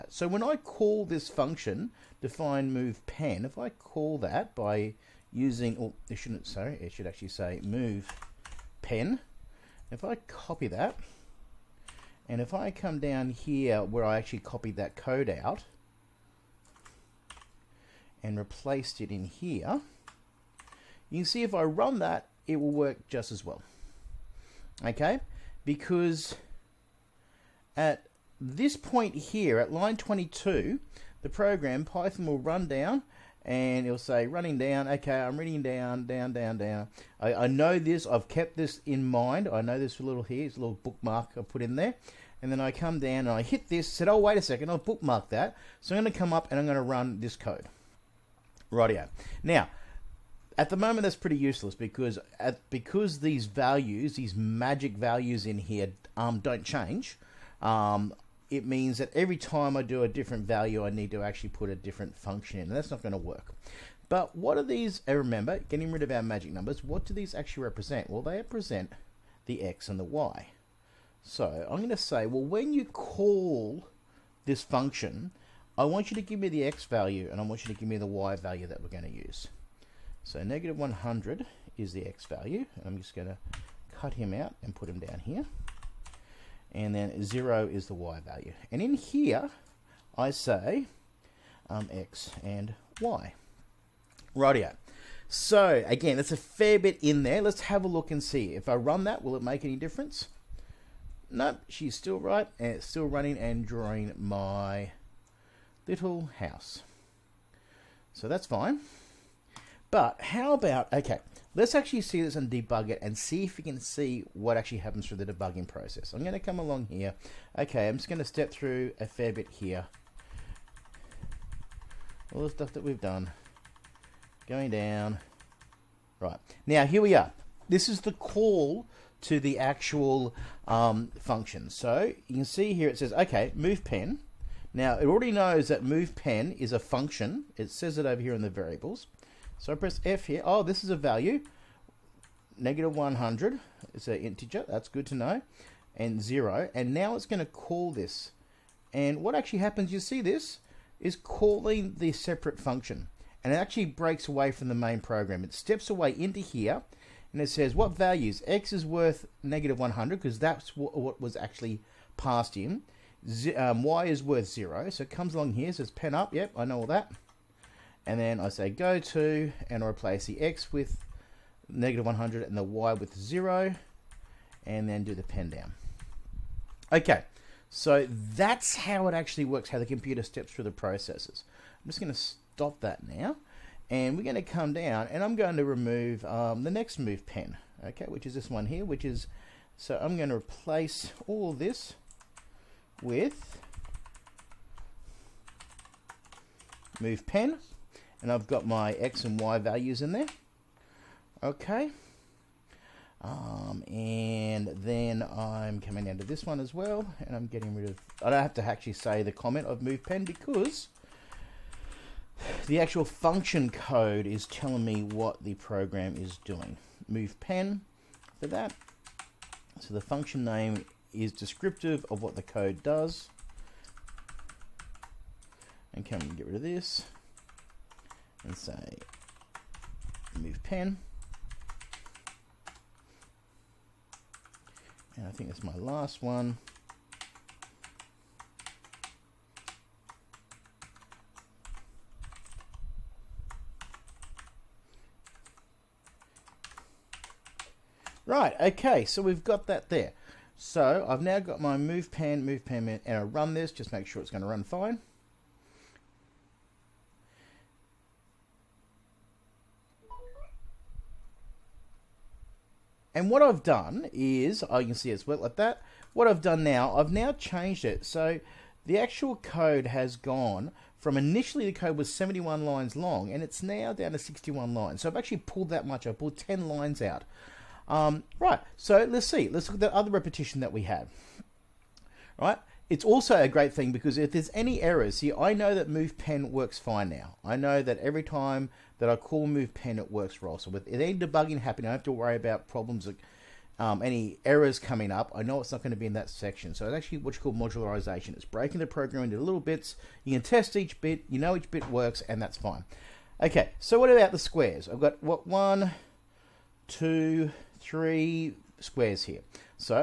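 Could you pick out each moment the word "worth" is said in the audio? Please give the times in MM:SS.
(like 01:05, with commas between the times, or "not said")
02:38, 02:44.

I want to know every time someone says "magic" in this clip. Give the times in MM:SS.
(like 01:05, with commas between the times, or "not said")
00:54, 01:06.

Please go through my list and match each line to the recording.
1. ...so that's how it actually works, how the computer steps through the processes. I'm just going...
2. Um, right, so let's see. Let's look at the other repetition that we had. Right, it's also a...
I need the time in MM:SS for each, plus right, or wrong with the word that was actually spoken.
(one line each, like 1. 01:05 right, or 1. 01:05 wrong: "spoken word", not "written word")
1. 02:57 right
2. 04:37 right.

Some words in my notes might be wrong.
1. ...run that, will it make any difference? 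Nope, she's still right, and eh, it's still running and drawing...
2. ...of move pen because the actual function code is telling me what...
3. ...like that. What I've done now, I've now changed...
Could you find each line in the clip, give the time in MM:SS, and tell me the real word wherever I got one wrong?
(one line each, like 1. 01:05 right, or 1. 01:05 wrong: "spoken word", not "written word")
1. 01:38 right
2. 03:29 right
3. 04:25 right.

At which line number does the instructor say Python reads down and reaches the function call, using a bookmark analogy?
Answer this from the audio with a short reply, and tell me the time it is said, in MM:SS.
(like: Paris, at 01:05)
22, at 00:29.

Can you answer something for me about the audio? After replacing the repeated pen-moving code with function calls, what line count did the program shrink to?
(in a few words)
61.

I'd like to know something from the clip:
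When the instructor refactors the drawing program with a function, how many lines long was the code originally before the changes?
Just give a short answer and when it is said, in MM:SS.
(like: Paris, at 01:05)
71, at 04:32.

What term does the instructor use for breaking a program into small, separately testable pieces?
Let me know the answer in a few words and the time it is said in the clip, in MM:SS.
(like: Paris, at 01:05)
modularization, at 04:57.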